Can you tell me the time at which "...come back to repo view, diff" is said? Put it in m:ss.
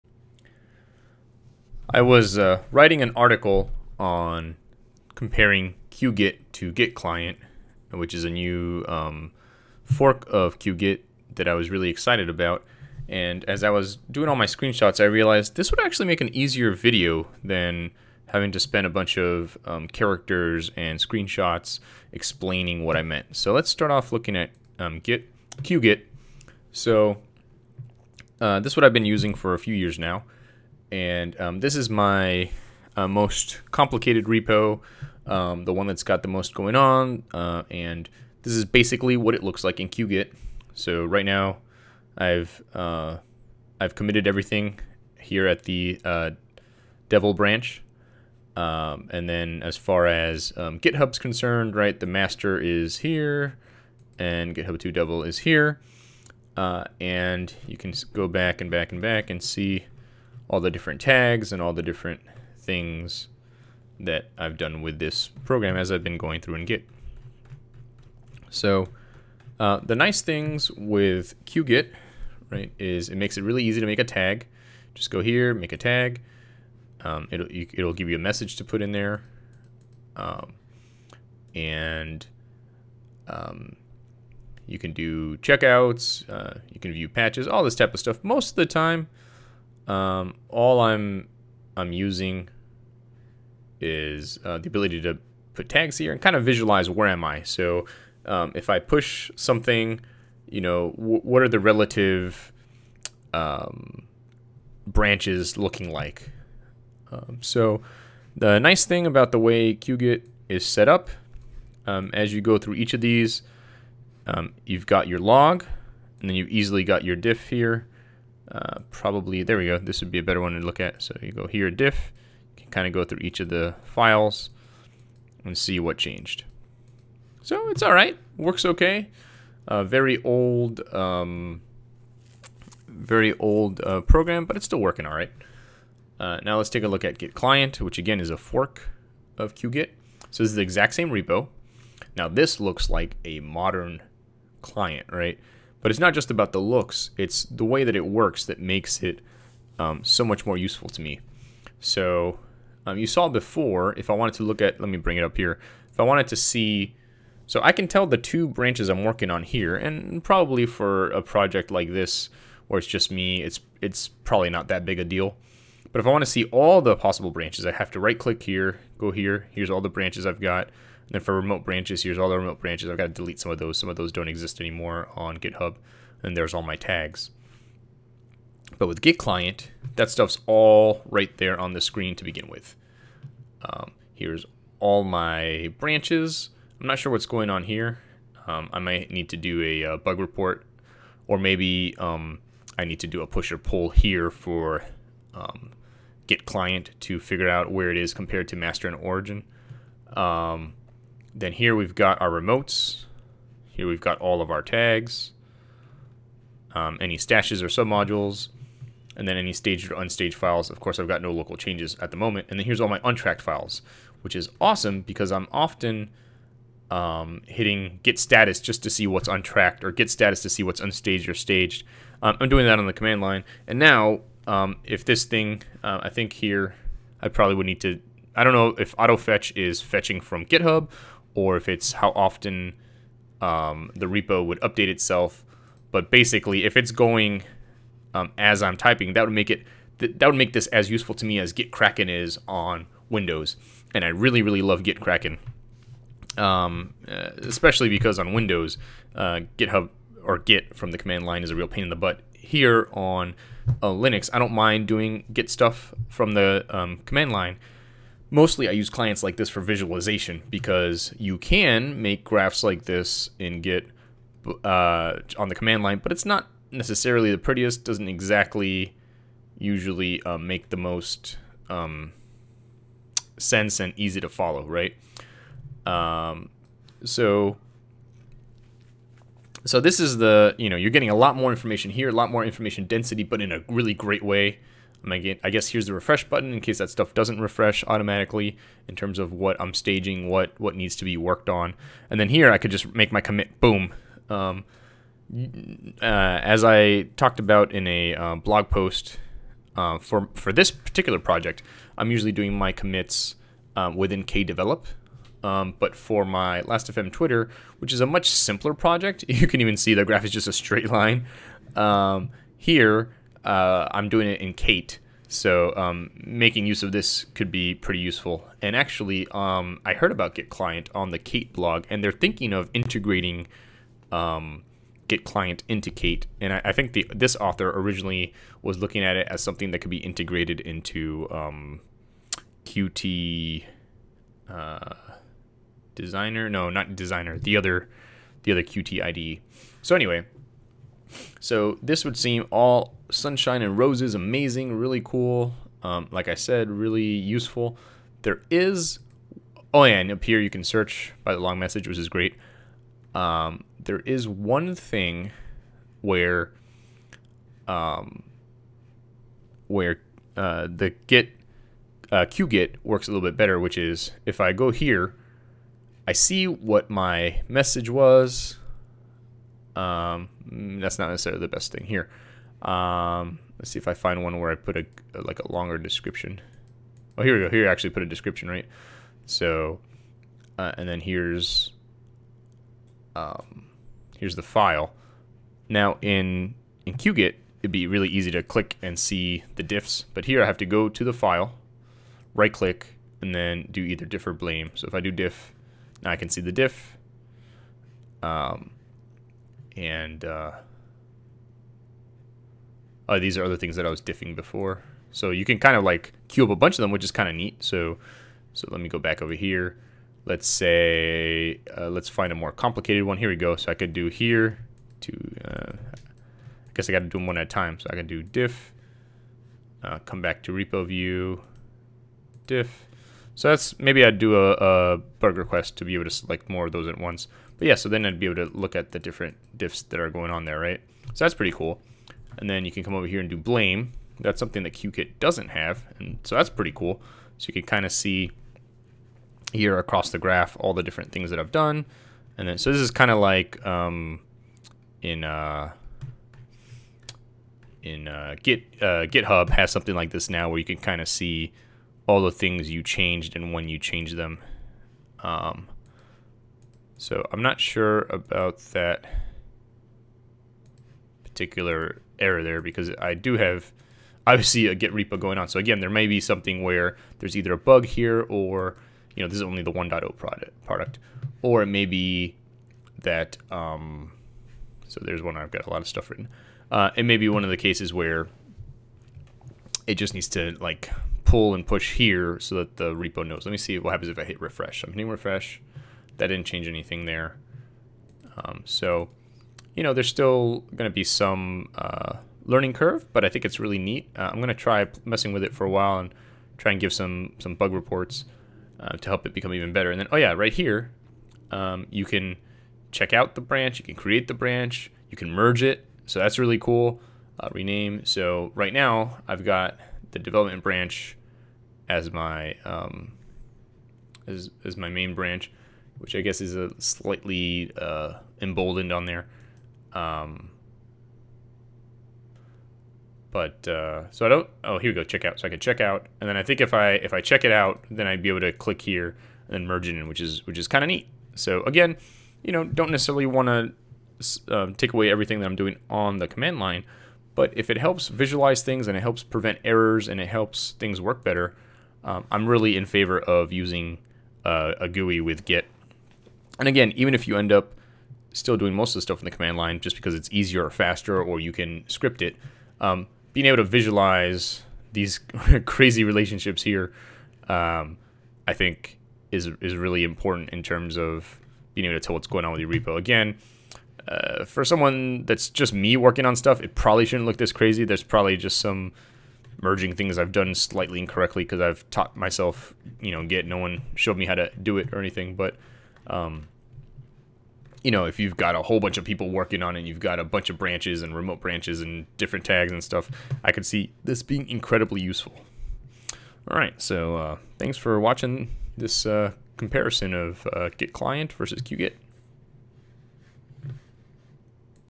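6:59.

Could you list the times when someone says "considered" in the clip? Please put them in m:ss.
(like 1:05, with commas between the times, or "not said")
not said.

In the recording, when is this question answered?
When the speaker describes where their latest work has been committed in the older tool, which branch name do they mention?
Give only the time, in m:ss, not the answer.
0:47.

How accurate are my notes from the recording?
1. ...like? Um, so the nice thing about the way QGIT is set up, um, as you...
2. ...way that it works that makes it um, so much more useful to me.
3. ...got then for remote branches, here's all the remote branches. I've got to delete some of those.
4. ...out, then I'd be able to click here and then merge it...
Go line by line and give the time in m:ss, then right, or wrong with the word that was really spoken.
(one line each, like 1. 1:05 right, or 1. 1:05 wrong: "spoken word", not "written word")
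1. 1:45 right
2. 2:27 right
3. 2:50 right
4. 8:47 right.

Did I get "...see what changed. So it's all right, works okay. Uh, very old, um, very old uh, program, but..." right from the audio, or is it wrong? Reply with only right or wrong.
right.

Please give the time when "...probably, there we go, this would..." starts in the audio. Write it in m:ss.
1:58.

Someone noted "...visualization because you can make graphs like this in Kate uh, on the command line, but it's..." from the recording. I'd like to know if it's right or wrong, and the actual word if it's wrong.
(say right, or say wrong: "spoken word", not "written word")
wrong: "Git", not "Kate".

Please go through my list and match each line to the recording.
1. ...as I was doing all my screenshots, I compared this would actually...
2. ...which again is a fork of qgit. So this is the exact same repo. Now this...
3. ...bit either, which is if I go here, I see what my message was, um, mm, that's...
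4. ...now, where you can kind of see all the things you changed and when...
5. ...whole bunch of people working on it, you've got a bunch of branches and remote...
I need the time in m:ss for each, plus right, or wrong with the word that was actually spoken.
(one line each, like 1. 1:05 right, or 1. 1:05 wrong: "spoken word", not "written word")
1. 0:13 wrong: "realized", not "compared"
2. 2:17 right
3. 6:03 wrong: "better", not "either"
4. 7:30 right
5. 9:38 right.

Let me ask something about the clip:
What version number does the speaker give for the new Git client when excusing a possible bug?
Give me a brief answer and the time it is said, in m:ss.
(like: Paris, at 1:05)
1.0, at 7:49.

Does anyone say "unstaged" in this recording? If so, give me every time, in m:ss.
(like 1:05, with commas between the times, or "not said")
3:29, 3:40.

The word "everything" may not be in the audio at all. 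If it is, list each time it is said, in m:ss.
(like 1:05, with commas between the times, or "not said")
0:44, 8:55.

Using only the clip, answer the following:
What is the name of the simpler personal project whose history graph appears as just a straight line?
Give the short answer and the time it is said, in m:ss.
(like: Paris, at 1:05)
Last.fm Twitter, at 5:06.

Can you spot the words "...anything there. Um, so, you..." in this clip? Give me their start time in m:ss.
8:06.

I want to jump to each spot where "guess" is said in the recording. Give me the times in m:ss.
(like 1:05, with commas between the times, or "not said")
4:45, 6:56, 8:36.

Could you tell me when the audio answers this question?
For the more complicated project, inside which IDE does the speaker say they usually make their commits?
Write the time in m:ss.
5:04.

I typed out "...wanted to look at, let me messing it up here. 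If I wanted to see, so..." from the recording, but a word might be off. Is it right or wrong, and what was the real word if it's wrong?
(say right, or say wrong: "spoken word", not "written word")
wrong: "bring", not "messing".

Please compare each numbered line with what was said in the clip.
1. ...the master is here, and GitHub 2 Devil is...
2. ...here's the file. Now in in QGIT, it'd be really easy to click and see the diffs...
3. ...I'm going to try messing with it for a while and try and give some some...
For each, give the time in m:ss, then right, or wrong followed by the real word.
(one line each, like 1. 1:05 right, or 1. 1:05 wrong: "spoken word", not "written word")
1. 0:51 right
2. 6:24 right
3. 8:14 right.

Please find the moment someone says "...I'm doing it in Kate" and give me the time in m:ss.
5:13.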